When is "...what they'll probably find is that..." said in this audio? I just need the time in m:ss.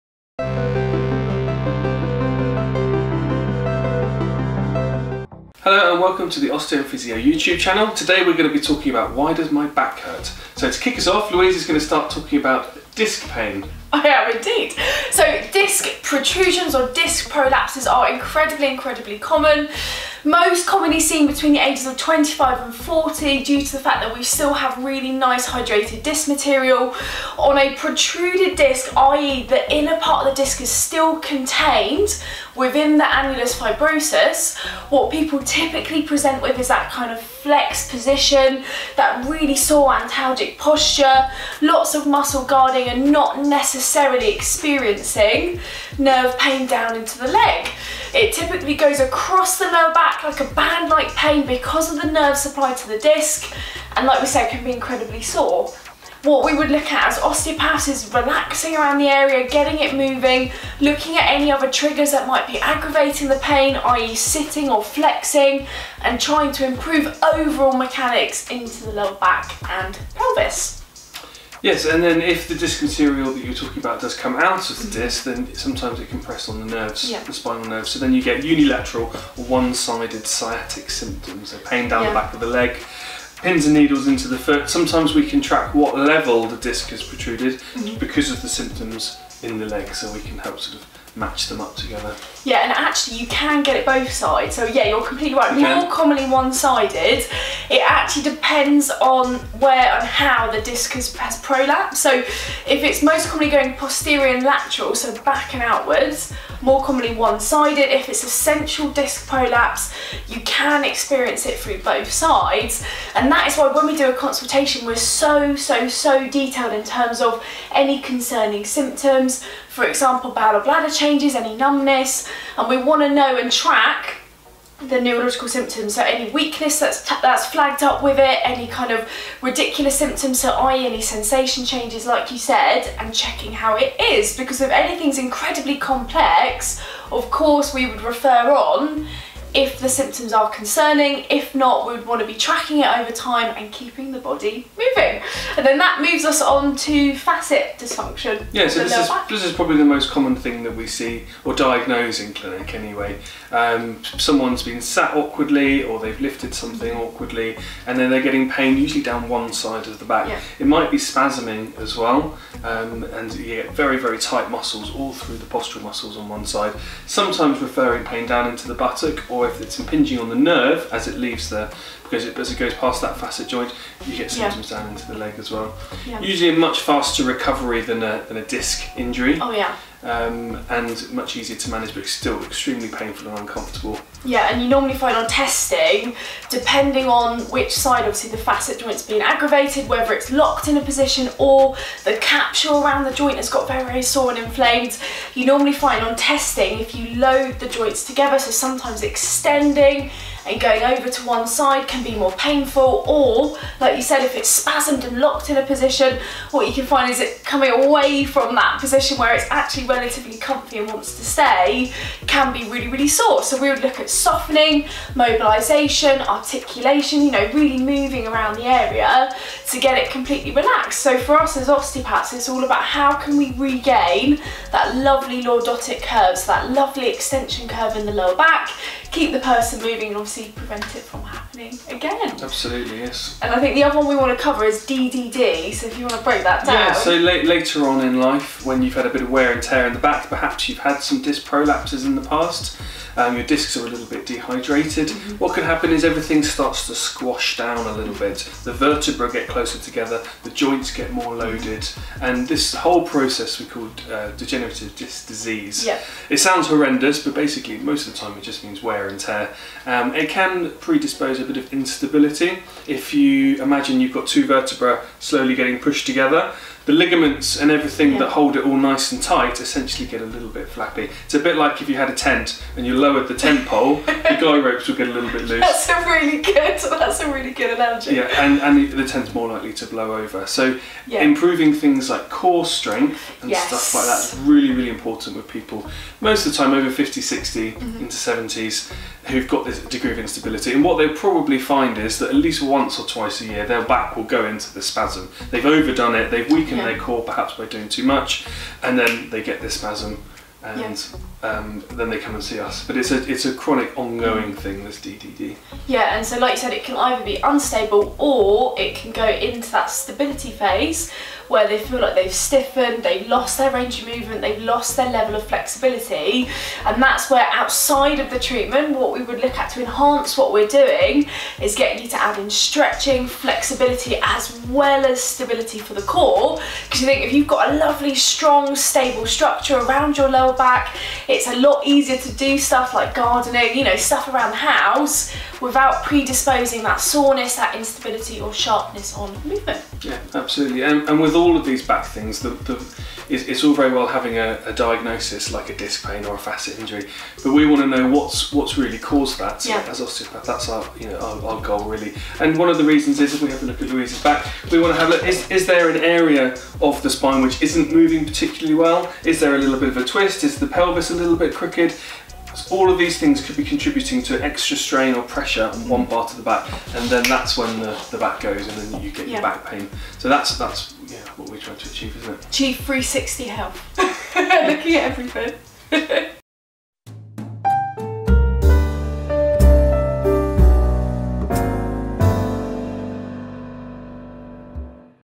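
4:50.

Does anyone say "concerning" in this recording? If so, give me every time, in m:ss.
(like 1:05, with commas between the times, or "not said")
1:58, 2:20.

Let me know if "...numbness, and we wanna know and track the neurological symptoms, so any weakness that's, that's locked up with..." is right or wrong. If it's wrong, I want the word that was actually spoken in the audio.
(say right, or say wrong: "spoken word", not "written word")
wrong: "flagged", not "locked".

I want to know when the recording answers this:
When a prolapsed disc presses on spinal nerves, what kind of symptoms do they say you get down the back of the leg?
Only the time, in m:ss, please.
1:20.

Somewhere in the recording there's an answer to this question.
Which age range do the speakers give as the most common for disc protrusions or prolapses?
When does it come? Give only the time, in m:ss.
0:21.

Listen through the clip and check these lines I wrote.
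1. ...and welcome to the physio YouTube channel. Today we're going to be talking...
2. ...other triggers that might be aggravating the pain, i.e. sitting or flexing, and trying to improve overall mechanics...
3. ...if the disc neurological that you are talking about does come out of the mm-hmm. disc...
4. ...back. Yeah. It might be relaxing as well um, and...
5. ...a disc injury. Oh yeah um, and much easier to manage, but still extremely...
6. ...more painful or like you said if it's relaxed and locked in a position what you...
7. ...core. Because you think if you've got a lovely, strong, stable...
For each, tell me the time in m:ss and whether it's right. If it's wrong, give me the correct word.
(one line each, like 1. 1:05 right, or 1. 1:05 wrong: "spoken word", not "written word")
1. 0:05 right
2. 1:01 right
3. 1:12 wrong: "material", not "neurological"
4. 2:40 wrong: "spasming", not "relaxing"
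5. 2:58 right
6. 3:22 wrong: "spasmed", not "relaxed"
7. 5:26 right.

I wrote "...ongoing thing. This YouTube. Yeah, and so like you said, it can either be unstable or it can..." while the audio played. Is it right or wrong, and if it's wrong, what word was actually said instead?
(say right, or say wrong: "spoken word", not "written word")
wrong: "DDD", not "YouTube".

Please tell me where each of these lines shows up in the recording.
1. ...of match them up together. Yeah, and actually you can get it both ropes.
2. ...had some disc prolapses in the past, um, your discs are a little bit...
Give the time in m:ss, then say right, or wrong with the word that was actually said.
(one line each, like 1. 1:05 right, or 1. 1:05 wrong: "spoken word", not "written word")
1. 1:30 wrong: "sides", not "ropes"
2. 4:00 right.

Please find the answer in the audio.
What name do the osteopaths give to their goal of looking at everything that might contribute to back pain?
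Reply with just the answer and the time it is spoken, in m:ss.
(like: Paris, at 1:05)
360 health, at 6:12.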